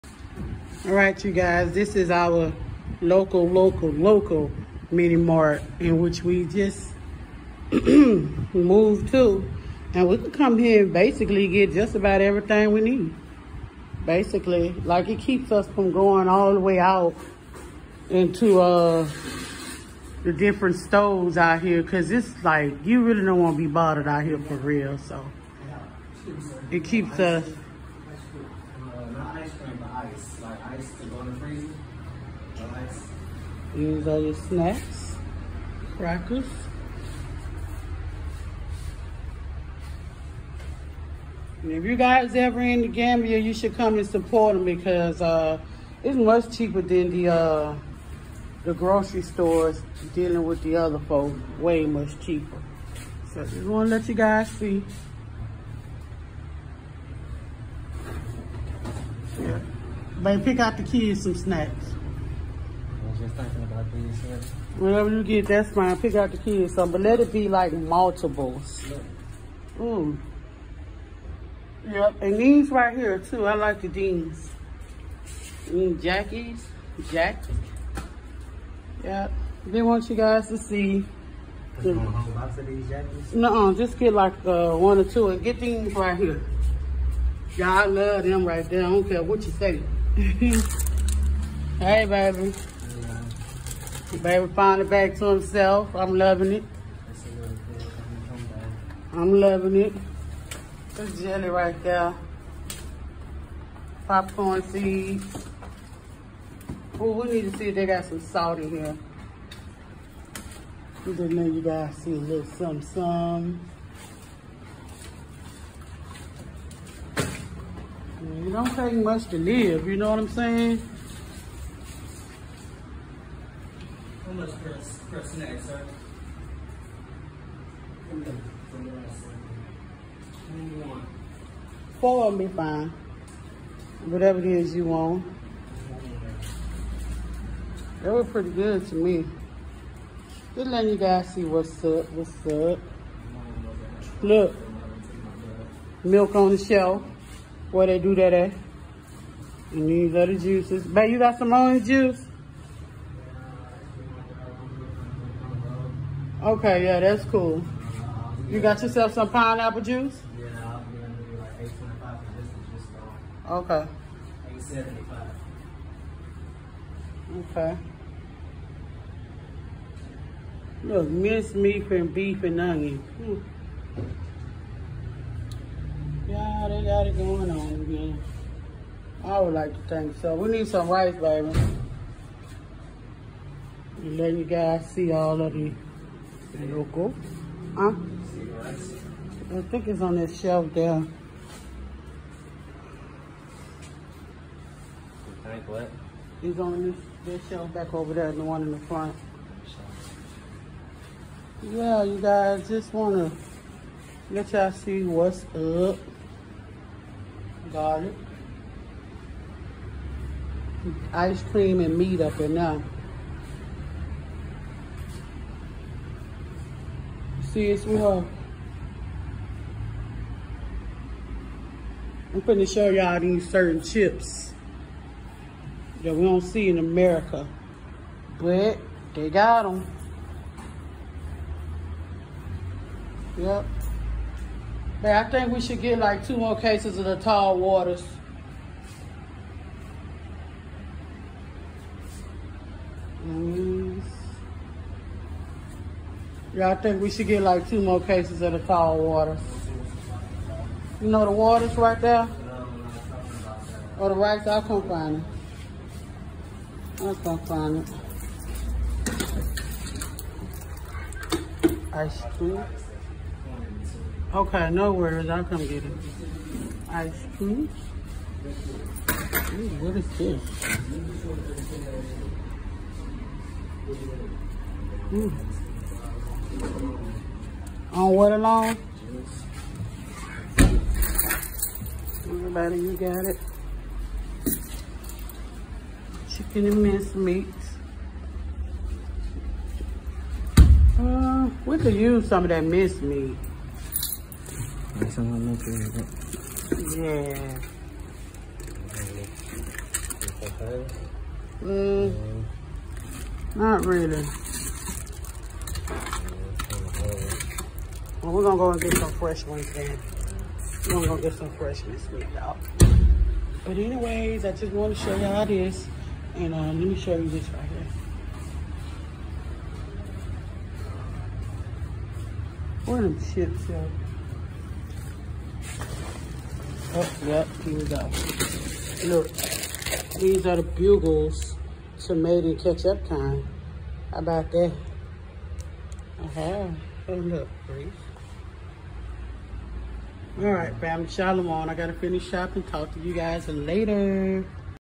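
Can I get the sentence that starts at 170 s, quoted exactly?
Look, minced meat and beef and onion.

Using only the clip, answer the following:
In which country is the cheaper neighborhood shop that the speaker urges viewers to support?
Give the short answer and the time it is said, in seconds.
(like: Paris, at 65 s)
The Gambia, at 42 s.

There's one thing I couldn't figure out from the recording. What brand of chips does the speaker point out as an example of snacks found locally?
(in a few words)
Bugles.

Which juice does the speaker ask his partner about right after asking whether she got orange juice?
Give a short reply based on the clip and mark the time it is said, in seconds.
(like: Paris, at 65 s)
Pineapple juice, at 159 s.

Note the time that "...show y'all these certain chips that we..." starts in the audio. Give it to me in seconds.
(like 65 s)
222 s.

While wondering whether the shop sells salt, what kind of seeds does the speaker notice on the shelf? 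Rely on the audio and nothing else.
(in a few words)
Popcorn seeds.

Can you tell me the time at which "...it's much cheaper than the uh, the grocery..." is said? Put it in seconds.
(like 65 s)
46 s.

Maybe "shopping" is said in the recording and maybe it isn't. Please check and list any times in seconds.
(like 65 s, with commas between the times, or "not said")
342 s.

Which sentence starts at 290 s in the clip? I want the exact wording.
Uh, we could use some of that minced meat.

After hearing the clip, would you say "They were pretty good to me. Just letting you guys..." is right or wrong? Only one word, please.
right.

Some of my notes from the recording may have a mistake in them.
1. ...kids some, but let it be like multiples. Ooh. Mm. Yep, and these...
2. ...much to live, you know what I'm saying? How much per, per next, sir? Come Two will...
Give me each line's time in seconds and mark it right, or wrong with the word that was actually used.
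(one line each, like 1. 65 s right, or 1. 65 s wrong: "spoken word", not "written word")
1. 66 s right
2. 118 s wrong: "Four", not "Two".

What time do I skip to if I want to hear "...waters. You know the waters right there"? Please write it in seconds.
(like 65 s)
248 s.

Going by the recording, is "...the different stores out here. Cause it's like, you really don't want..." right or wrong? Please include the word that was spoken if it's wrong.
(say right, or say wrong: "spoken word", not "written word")
right.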